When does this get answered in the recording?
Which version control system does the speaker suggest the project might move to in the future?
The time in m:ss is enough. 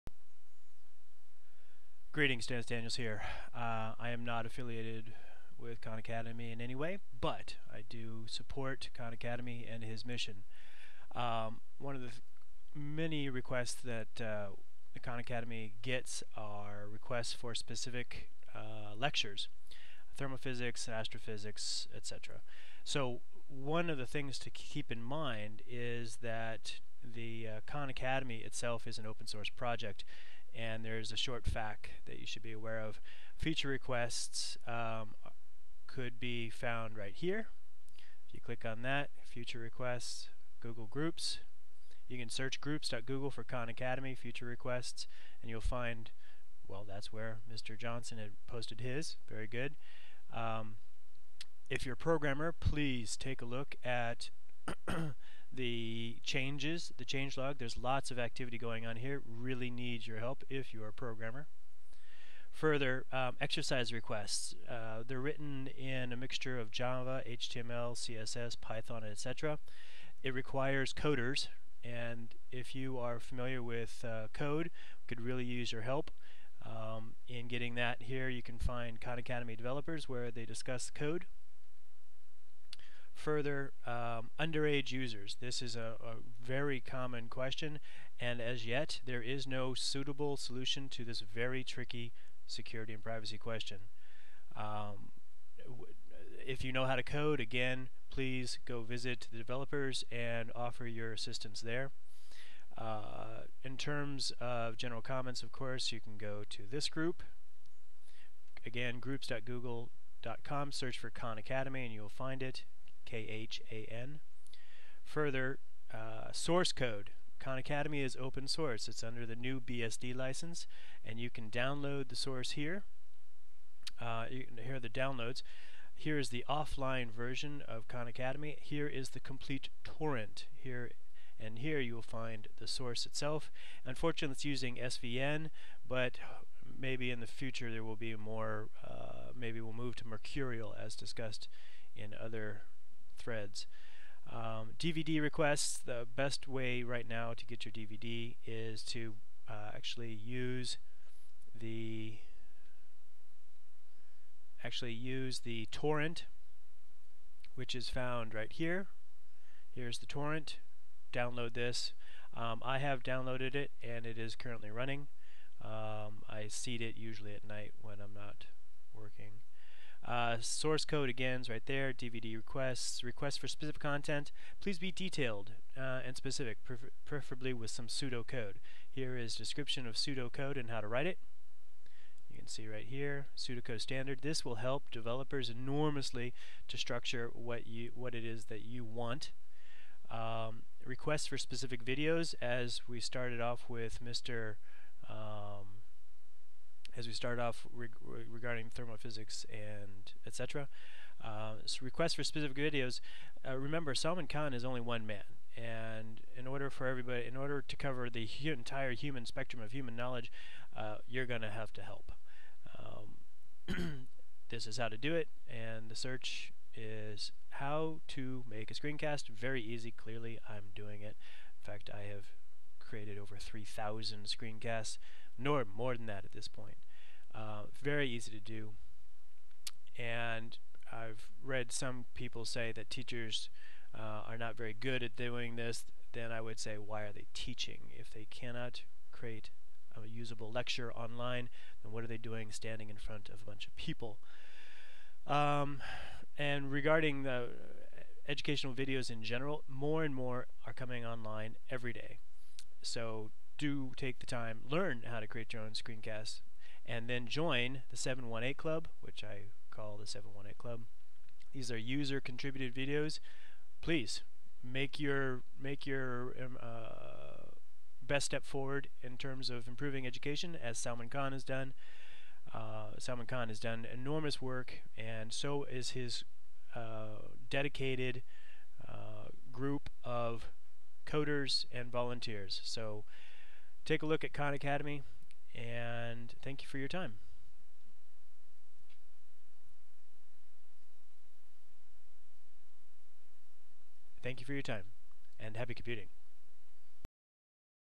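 2:20.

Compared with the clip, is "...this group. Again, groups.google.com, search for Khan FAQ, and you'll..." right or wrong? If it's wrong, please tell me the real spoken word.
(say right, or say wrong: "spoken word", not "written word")
wrong: "Academy", not "FAQ".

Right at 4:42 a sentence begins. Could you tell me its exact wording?
So take a look at Khan Academy and thank you for your time.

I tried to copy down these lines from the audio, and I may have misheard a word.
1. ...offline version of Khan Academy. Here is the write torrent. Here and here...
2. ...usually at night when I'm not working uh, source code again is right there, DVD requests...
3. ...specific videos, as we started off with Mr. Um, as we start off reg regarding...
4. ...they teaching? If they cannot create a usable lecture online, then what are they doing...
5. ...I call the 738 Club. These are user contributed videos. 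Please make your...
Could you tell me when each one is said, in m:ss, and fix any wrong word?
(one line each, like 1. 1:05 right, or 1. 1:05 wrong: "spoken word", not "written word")
1. 2:06 wrong: "complete", not "write"
2. 2:46 right
3. 3:11 right
4. 3:57 right
5. 4:19 wrong: "718", not "738".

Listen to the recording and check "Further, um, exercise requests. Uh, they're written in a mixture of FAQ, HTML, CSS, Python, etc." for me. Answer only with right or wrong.
wrong.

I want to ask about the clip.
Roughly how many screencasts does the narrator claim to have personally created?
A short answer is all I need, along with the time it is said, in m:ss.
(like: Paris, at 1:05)
3,000, at 3:43.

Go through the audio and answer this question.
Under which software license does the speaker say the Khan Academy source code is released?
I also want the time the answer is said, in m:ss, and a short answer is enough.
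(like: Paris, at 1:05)
new BSD license, at 1:59.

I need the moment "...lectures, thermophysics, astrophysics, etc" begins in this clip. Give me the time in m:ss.
0:18.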